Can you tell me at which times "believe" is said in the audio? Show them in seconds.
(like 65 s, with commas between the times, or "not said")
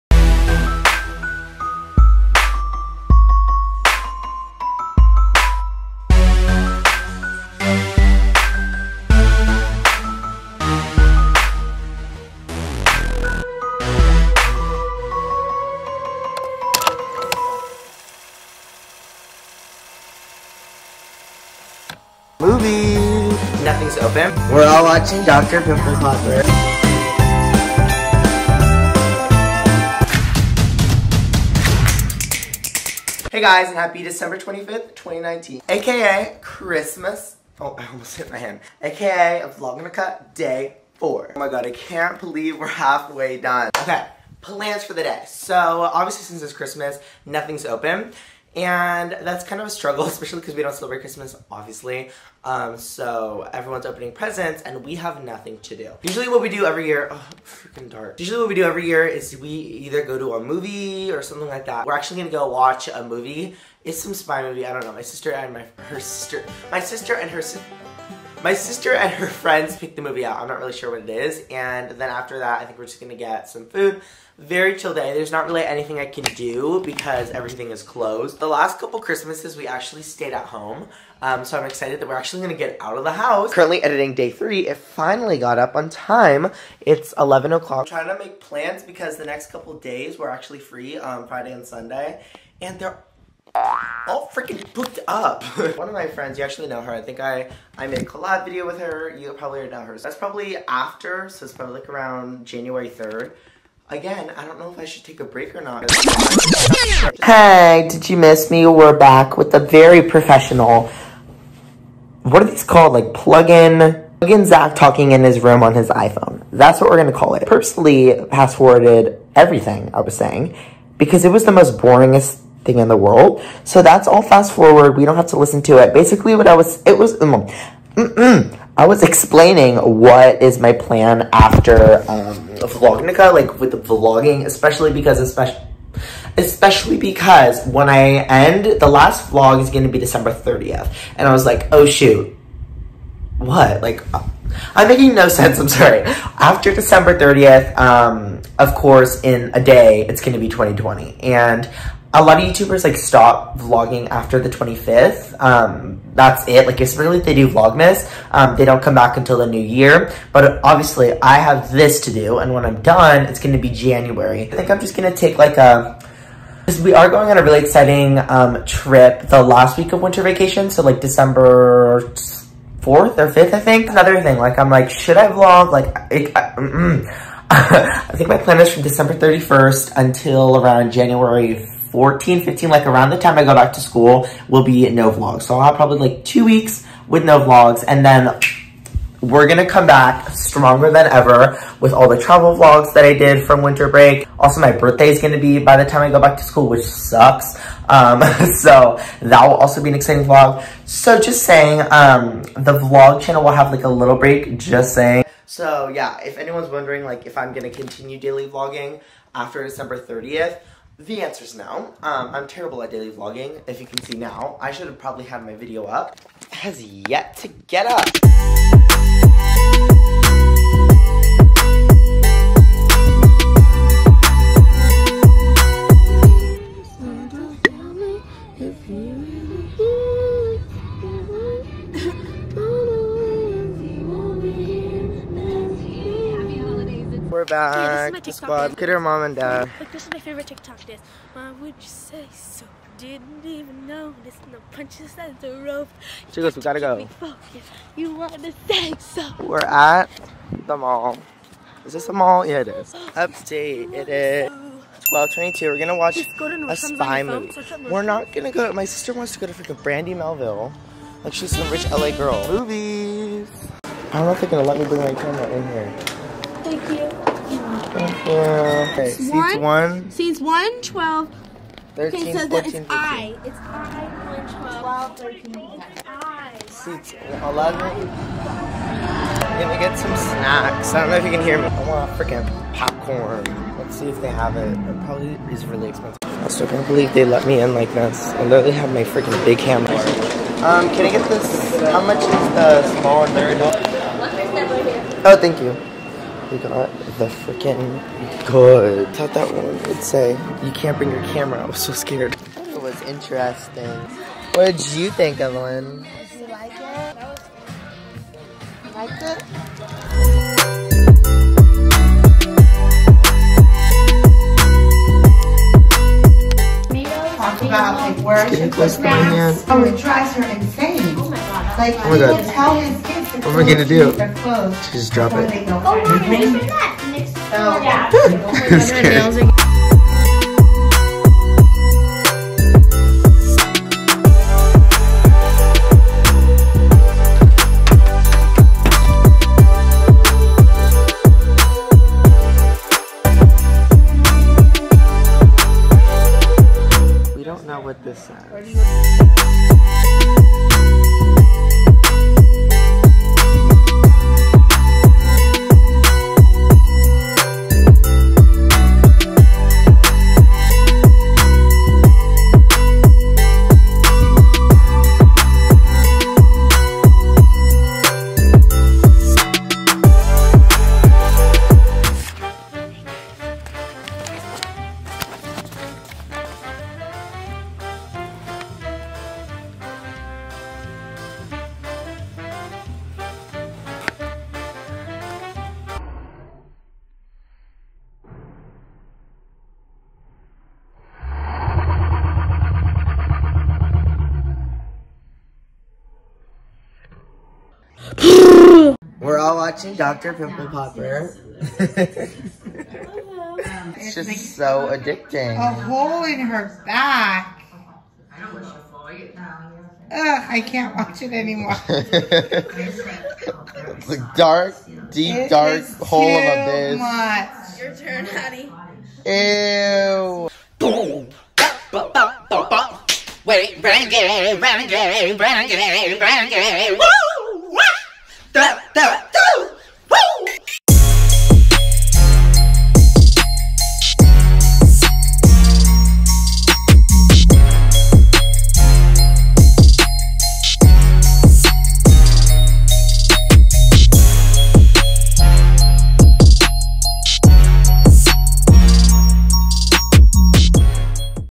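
42 s, 286 s.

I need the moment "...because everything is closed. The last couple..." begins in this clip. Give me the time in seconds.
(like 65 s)
76 s.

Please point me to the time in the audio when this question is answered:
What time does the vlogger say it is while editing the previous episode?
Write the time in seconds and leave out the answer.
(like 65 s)
87 s.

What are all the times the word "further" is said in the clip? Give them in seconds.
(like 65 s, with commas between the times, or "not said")
not said.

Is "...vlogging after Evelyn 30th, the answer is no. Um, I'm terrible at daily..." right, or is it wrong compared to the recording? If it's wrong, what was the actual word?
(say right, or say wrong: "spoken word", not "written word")
wrong: "December", not "Evelyn".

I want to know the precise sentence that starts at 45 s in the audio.
So obviously since it's Christmas, nothing's open.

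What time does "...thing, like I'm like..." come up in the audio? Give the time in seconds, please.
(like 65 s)
174 s.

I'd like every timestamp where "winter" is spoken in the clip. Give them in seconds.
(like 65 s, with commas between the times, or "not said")
170 s, 193 s.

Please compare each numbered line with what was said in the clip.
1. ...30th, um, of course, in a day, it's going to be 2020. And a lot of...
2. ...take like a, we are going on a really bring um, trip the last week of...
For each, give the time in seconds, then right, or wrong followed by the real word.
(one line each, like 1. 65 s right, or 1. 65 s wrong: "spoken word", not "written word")
1. 147 s right
2. 165 s wrong: "exciting", not "bring".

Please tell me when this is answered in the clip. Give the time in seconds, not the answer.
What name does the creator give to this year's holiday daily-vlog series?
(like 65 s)
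132 s.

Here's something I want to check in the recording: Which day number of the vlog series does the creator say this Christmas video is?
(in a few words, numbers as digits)
Day 4.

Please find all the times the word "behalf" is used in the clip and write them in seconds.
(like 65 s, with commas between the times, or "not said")
not said.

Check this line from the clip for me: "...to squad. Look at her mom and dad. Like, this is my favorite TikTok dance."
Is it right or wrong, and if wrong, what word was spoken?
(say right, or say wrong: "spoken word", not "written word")
right.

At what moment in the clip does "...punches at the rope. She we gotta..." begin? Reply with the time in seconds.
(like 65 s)
244 s.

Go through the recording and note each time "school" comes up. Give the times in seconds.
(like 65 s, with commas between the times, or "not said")
183 s, 196 s.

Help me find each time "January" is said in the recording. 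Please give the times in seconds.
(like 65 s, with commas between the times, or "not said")
102 s, 163 s, 180 s.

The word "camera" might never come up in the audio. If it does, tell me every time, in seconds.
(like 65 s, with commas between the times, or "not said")
265 s, 301 s.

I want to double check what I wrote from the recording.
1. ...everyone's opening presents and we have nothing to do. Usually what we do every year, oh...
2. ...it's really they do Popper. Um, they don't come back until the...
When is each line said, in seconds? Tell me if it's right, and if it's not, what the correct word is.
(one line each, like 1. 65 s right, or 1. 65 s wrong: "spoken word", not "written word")
1. 53 s right
2. 156 s wrong: "Vlogmas", not "Popper".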